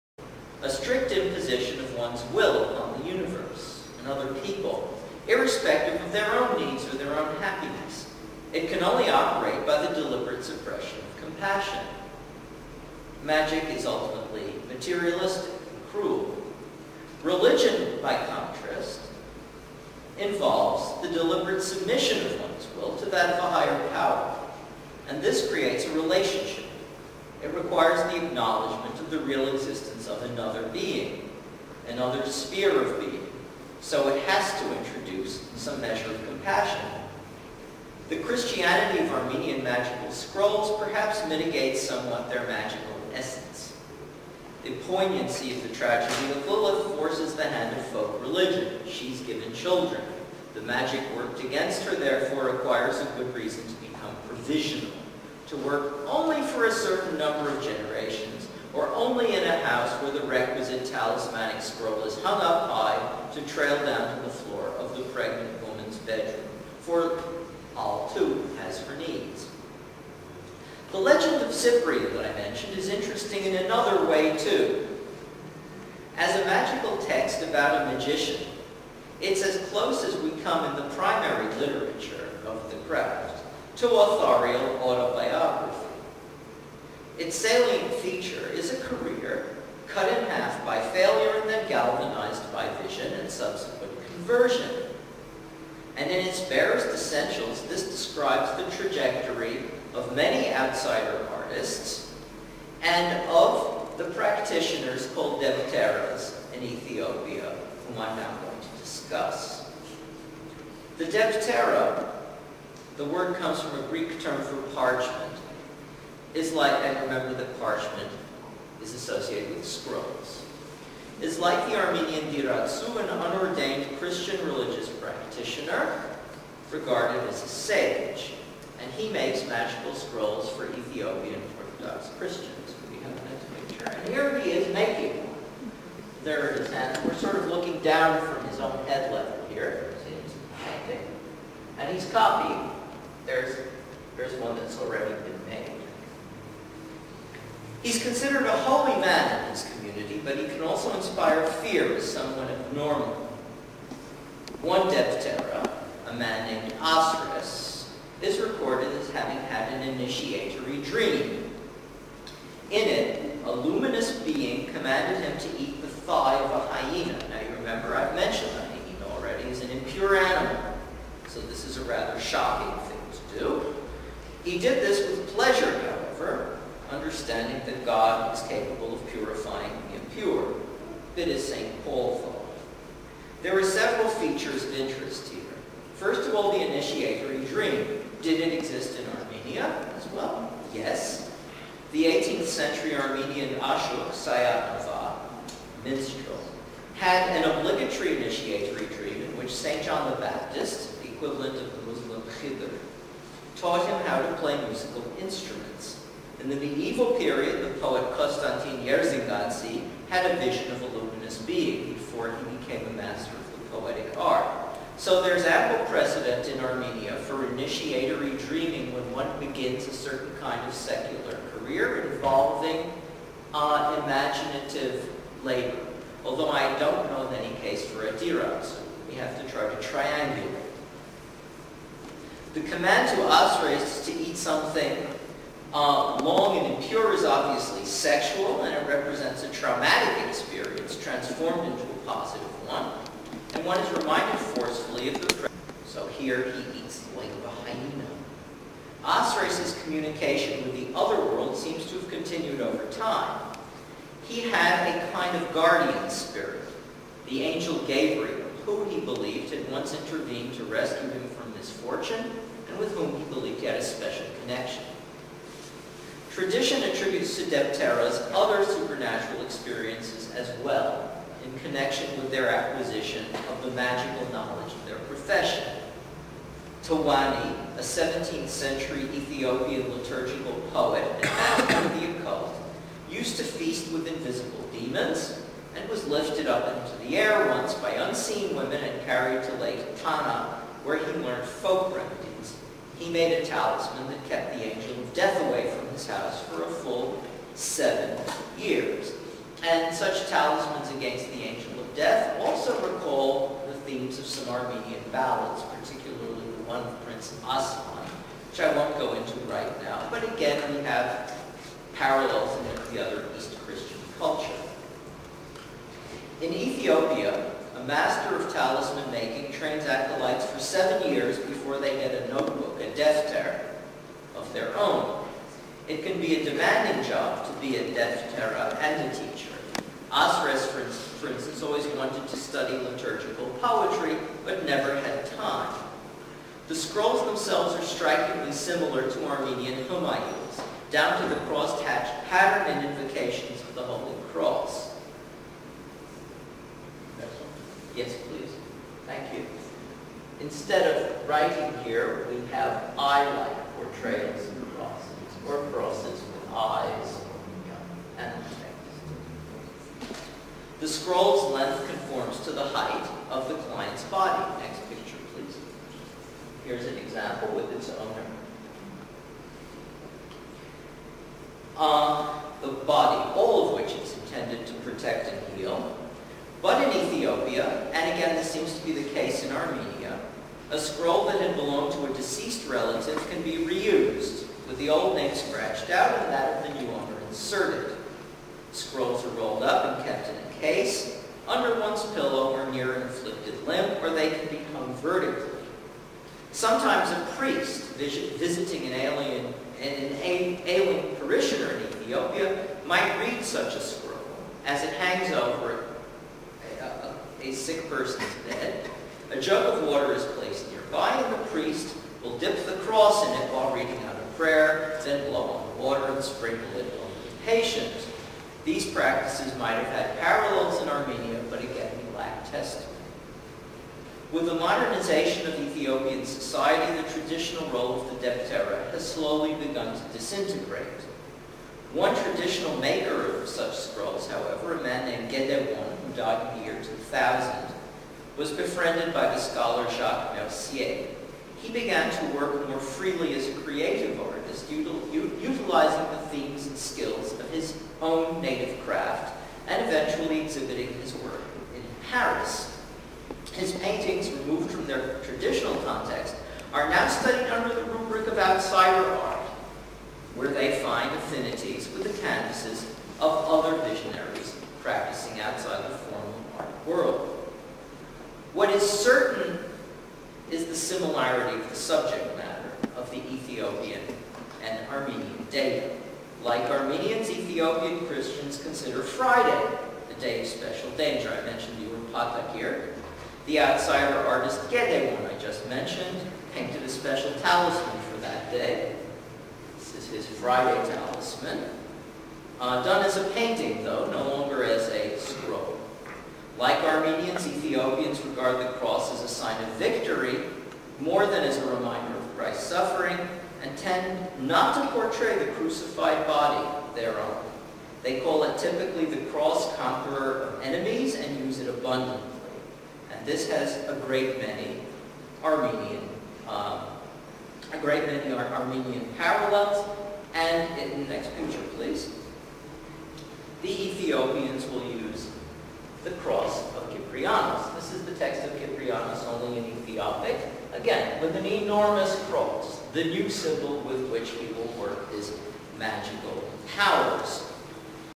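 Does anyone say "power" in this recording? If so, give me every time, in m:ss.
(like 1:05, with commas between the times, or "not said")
0:23, 8:56.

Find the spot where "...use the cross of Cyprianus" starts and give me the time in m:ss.
8:44.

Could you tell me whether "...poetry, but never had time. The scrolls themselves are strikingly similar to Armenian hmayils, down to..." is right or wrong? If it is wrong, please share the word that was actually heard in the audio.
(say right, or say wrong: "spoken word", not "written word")
right.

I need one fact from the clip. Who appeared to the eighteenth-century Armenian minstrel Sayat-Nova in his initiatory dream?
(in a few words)
St. John the Baptist.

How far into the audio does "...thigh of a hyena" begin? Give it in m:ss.
2:45.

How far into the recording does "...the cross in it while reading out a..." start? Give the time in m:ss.
6:52.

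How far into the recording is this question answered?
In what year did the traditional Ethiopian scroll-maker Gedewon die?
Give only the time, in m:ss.
7:16.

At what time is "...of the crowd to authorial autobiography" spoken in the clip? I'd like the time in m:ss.
1:22.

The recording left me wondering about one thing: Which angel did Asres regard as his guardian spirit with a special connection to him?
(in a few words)
Gabriel.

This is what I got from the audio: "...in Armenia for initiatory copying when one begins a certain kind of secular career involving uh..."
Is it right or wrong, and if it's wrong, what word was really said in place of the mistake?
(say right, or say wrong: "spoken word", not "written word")
wrong: "dreaming", not "copying".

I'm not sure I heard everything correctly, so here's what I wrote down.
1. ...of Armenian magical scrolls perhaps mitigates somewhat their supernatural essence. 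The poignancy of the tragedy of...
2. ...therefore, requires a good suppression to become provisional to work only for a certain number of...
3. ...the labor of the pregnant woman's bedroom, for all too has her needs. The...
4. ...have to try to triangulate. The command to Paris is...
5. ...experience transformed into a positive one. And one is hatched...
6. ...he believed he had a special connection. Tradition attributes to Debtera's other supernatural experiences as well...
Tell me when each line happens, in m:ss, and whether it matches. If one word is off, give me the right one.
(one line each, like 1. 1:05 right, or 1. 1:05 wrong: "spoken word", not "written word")
1. 0:39 wrong: "magical", not "supernatural"
2. 0:51 wrong: "reason", not "suppression"
3. 1:04 wrong: "floor", not "labor"
4. 3:49 wrong: "Asra", not "Paris"
5. 4:00 wrong: "reminded", not "hatched"
6. 4:23 right.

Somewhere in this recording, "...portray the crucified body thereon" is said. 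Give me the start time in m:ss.
8:24.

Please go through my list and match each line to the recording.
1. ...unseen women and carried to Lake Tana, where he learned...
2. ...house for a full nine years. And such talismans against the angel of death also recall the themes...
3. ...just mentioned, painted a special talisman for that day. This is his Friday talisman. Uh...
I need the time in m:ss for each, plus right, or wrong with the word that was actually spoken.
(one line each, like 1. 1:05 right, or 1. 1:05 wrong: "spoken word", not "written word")
1. 4:47 right
2. 4:56 wrong: "seven", not "nine"
3. 8:05 right.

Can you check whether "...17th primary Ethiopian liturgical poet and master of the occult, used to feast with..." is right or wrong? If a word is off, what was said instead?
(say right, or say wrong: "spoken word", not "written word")
wrong: "century", not "primary".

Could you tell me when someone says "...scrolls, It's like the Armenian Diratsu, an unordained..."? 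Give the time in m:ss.
1:59.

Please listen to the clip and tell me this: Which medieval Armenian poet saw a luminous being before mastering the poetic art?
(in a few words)
Konstantin Yerzingansky.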